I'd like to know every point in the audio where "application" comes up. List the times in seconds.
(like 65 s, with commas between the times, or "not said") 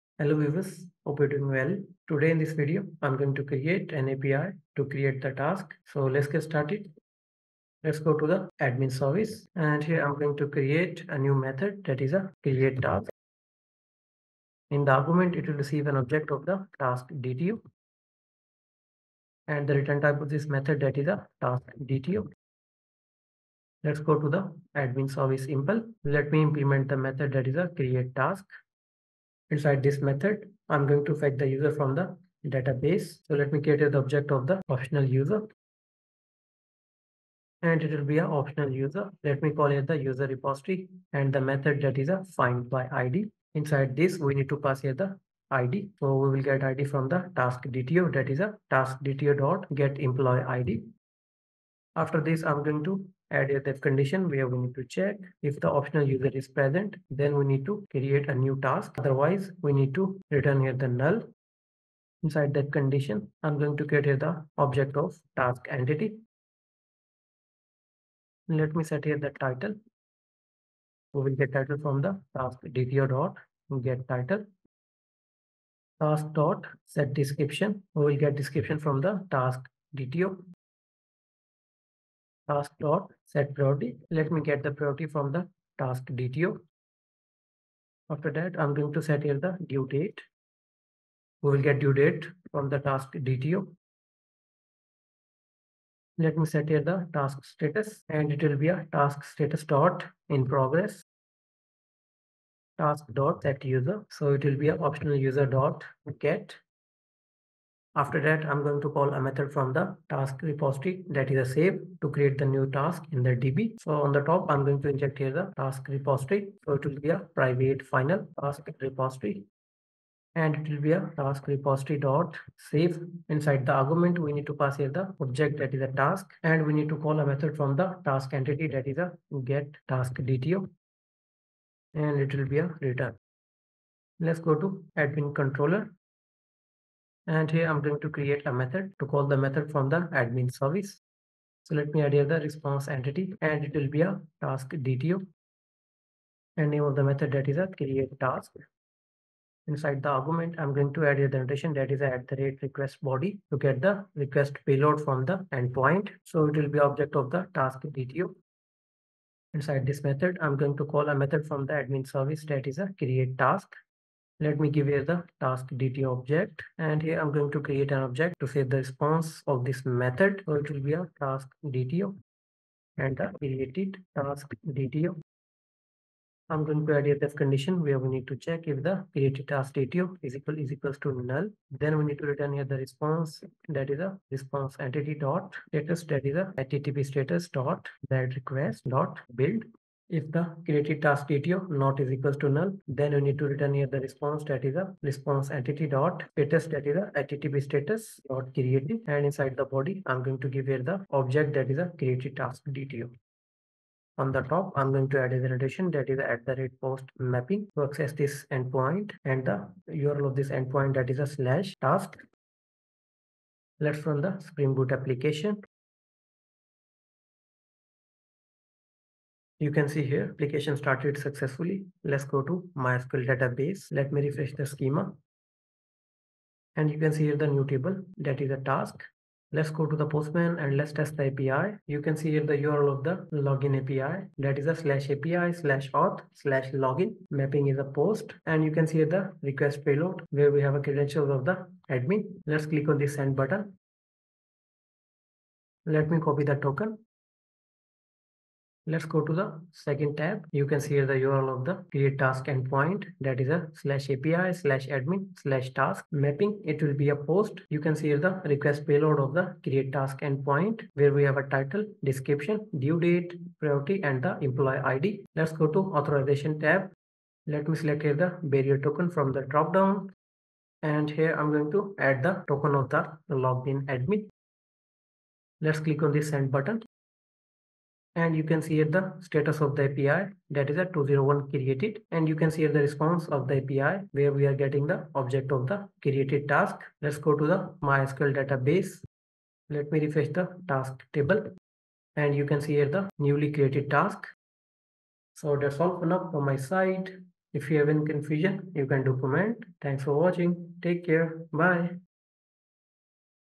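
214 s, 220 s.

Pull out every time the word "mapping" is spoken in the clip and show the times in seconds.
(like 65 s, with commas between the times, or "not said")
207 s, 237 s, 256 s.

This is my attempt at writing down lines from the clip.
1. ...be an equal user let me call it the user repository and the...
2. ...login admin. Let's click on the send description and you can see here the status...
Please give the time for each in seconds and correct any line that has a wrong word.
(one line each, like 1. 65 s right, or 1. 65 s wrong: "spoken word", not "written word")
1. 38 s wrong: "optional", not "equal"
2. 273 s wrong: "button", not "description".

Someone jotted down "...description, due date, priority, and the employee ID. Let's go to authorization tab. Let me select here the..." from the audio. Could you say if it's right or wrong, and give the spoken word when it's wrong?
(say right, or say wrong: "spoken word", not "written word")
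right.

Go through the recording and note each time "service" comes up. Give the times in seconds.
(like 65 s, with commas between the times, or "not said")
8 s, 25 s, 140 s, 162 s.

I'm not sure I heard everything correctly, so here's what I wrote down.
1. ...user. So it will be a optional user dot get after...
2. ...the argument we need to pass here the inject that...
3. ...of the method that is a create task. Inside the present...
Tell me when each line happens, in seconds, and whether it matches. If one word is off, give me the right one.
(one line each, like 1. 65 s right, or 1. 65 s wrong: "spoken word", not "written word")
1. 103 s right
2. 123 s wrong: "object", not "inject"
3. 146 s wrong: "argument", not "present".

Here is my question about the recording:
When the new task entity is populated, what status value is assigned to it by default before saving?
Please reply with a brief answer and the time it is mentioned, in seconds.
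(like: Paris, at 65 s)
In progress, at 100 s.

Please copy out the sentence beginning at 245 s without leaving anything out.
Let me copy the token Let's go to the second tab.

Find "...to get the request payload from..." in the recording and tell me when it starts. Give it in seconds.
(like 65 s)
153 s.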